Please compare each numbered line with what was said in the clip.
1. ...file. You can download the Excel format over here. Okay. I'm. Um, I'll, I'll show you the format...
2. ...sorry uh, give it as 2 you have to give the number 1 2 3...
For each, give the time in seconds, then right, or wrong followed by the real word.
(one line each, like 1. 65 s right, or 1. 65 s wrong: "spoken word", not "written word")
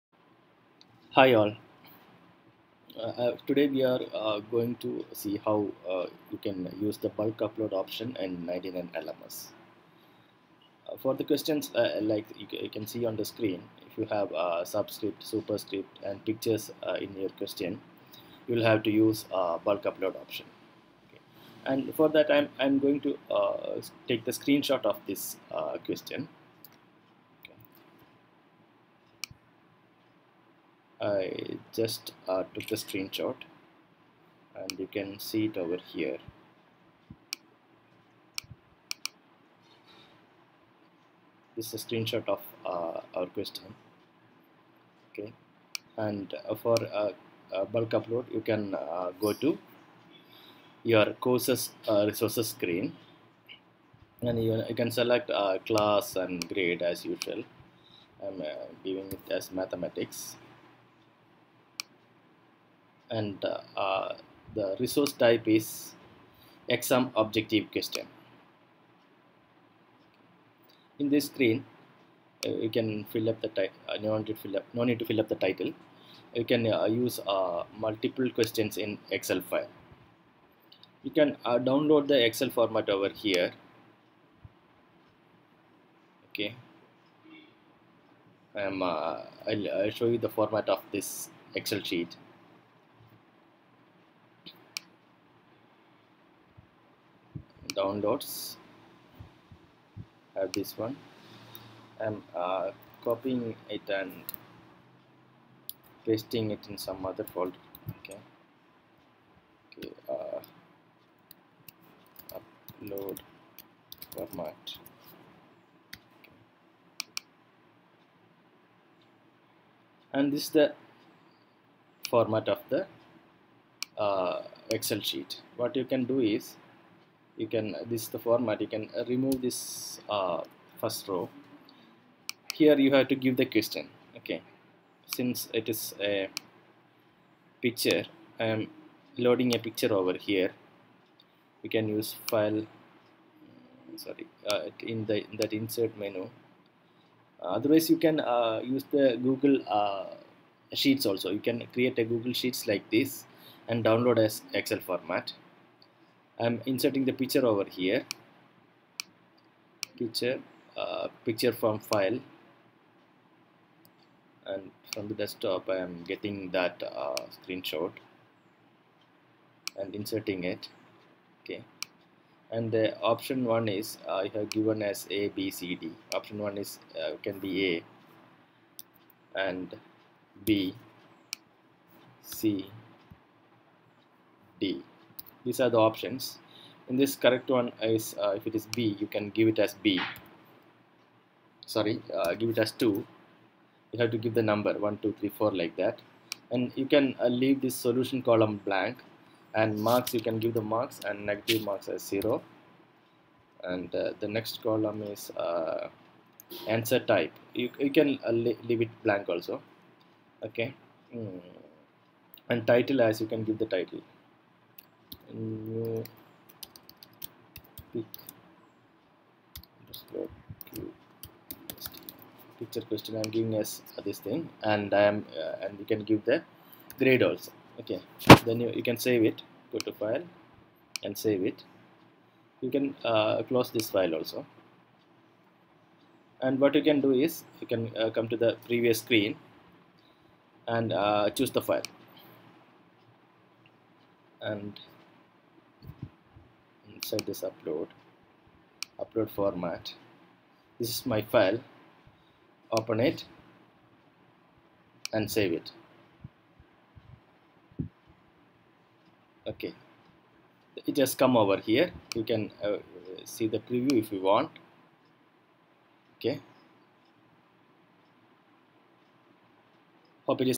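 1. 79 s right
2. 191 s right.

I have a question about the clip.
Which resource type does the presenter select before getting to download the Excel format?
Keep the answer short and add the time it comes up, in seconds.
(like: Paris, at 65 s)
Exam objective question, at 66 s.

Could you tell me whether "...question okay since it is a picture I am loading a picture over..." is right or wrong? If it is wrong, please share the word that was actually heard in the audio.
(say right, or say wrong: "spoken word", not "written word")
right.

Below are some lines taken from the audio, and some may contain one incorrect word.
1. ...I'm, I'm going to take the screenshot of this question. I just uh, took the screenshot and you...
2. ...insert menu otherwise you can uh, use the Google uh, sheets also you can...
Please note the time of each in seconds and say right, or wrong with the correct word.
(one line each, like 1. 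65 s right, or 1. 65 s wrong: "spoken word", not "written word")
1. 22 s right
2. 145 s right.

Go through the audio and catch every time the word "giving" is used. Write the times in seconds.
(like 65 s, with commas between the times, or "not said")
58 s, 223 s.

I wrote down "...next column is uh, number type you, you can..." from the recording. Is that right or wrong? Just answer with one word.
wrong.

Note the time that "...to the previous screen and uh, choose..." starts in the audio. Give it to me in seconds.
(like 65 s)
238 s.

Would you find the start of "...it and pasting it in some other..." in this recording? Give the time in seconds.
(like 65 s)
103 s.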